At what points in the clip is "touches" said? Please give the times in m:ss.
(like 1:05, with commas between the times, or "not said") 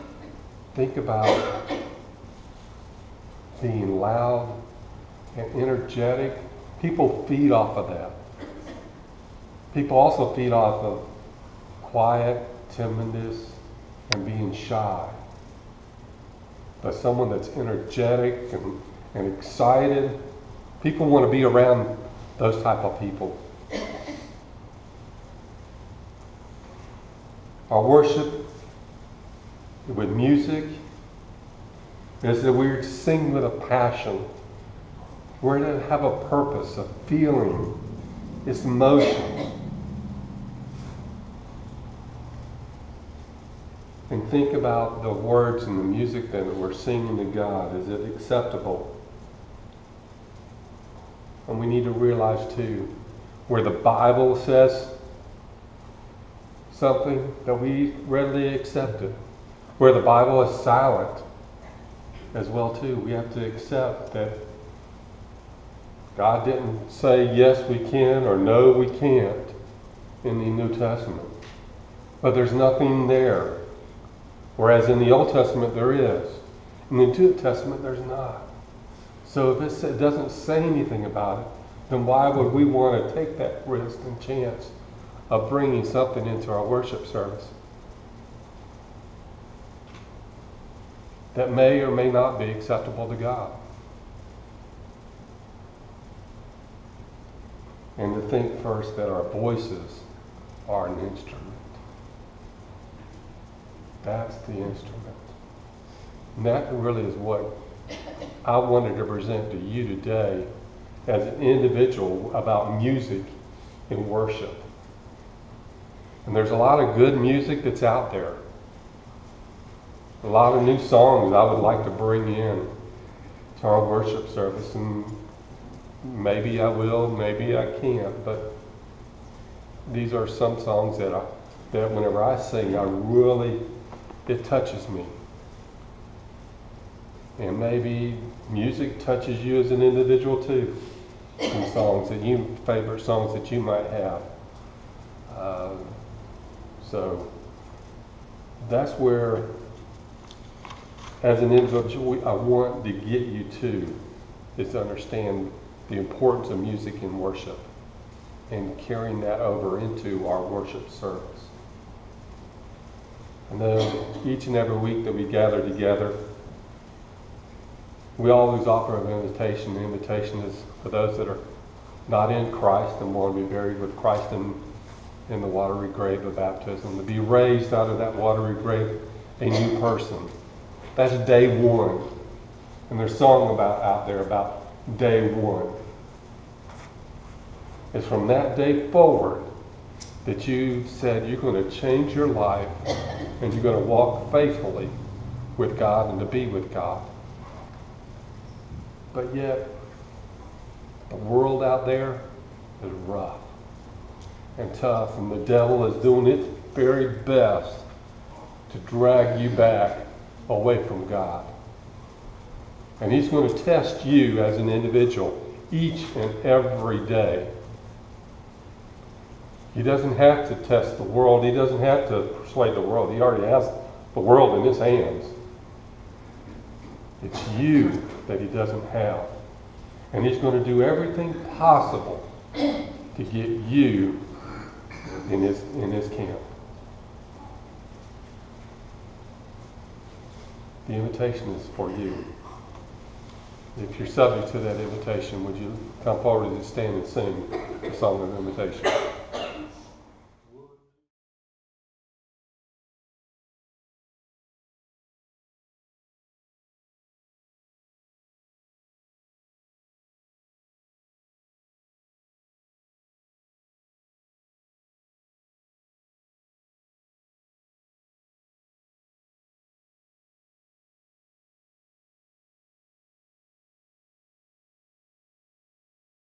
2:14, 2:19.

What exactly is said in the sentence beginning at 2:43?
I know each and every week that we gather together, we always offer an invitation.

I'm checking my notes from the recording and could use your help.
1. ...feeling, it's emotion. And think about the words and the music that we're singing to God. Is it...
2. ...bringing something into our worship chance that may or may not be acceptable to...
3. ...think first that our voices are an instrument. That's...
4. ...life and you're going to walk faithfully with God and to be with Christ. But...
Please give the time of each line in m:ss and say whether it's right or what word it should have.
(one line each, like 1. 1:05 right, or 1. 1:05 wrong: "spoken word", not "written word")
1. 0:37 right
2. 1:25 wrong: "service", not "chance"
3. 1:38 right
4. 3:12 wrong: "God", not "Christ".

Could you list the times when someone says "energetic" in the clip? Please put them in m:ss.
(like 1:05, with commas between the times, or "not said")
0:05, 0:17.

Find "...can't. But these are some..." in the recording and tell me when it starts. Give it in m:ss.
2:07.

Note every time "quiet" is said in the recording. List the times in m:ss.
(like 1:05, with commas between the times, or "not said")
0:11.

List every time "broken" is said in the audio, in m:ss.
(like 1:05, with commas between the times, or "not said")
not said.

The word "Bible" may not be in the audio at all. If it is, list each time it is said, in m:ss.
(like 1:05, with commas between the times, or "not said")
0:53, 1:00.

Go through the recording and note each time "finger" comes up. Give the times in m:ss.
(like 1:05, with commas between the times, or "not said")
not said.